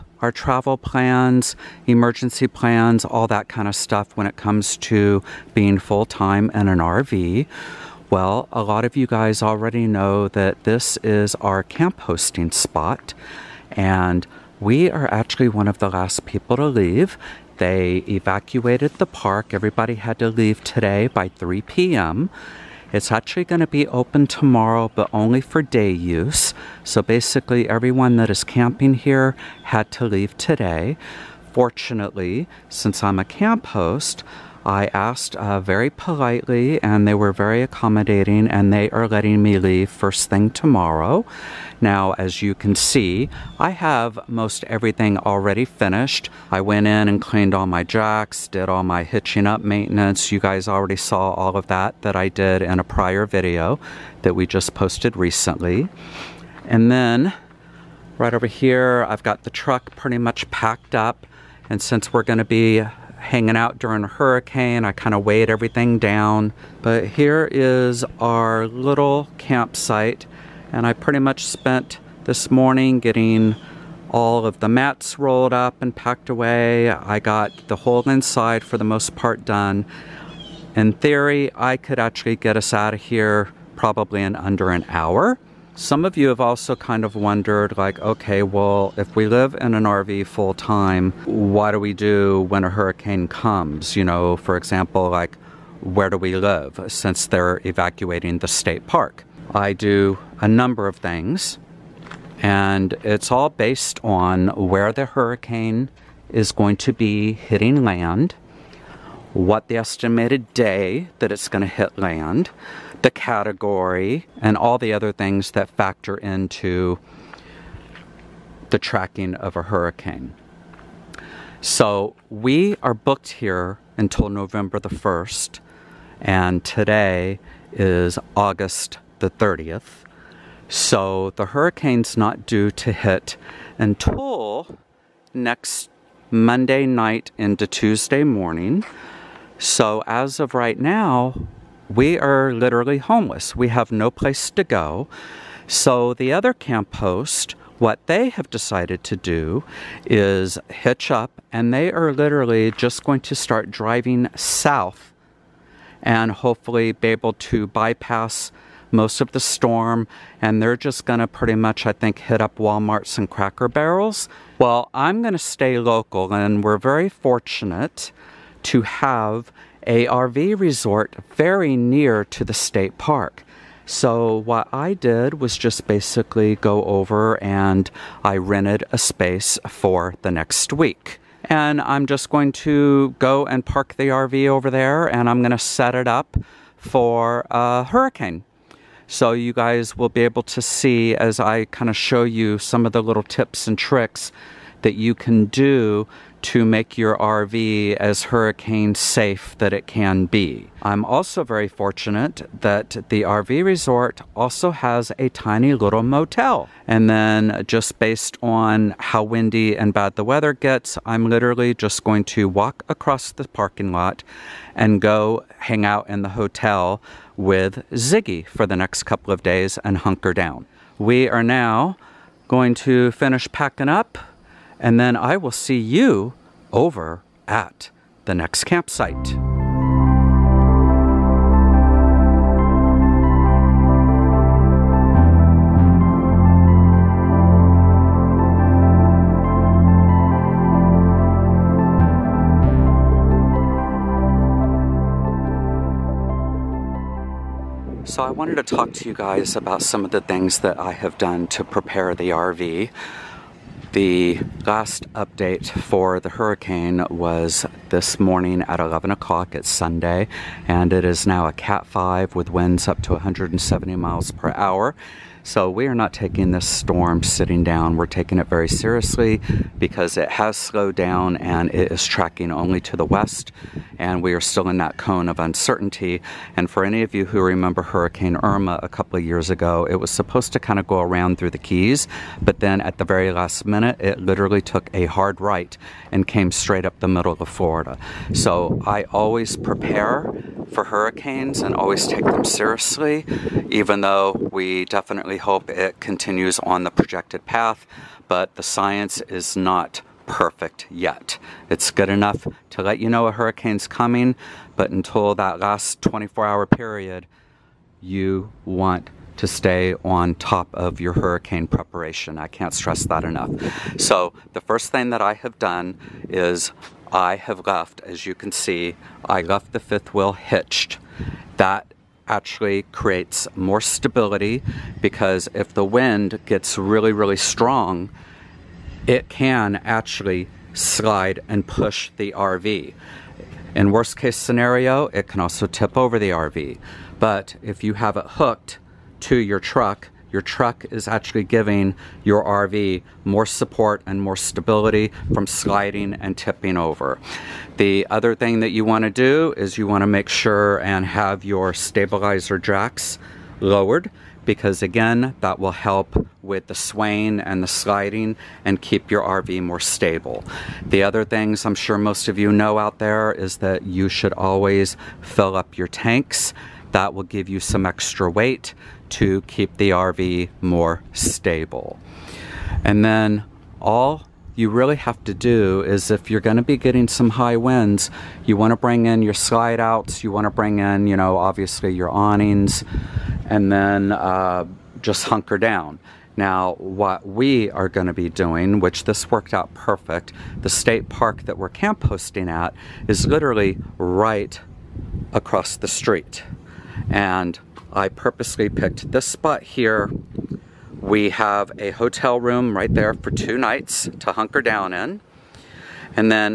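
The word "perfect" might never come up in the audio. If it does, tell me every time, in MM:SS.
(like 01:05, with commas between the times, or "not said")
05:00, 06:29.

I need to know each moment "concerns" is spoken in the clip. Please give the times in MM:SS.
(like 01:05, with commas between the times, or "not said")
not said.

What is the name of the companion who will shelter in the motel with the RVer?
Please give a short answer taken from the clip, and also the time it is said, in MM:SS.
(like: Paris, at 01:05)
Ziggy, at 03:37.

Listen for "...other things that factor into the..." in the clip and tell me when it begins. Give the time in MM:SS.
01:54.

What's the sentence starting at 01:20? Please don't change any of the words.
In theory, I could actually get us out of here probably in under an hour.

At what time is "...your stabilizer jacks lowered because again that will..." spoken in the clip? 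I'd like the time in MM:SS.
05:51.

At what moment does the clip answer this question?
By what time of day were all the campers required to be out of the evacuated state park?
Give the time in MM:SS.
00:21.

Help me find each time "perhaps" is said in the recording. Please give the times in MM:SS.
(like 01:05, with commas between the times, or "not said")
not said.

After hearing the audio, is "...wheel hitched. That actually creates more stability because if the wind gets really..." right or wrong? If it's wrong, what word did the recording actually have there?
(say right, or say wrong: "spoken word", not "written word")
right.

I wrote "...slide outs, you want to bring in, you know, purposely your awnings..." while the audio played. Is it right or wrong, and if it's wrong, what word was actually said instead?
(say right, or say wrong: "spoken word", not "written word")
wrong: "obviously", not "purposely".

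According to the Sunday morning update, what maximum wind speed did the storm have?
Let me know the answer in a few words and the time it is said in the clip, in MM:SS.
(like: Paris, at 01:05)
170 mph, at 04:23.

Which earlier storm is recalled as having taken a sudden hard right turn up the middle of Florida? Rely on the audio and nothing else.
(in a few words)
Hurricane Irma.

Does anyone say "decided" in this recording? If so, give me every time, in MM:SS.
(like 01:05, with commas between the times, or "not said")
02:28.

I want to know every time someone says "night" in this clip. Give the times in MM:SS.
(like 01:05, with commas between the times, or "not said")
02:16, 06:43.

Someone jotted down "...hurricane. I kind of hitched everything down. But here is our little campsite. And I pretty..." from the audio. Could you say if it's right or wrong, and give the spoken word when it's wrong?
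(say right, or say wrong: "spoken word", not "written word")
wrong: "weighed", not "hitched".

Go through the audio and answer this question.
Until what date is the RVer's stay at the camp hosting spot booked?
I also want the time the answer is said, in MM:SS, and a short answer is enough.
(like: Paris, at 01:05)
November 1st, at 02:04.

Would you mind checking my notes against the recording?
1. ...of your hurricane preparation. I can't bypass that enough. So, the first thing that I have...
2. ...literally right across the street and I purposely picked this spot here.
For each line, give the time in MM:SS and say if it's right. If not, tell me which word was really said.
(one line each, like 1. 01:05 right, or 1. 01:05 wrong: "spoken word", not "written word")
1. 05:10 wrong: "stress", not "bypass"
2. 06:33 right.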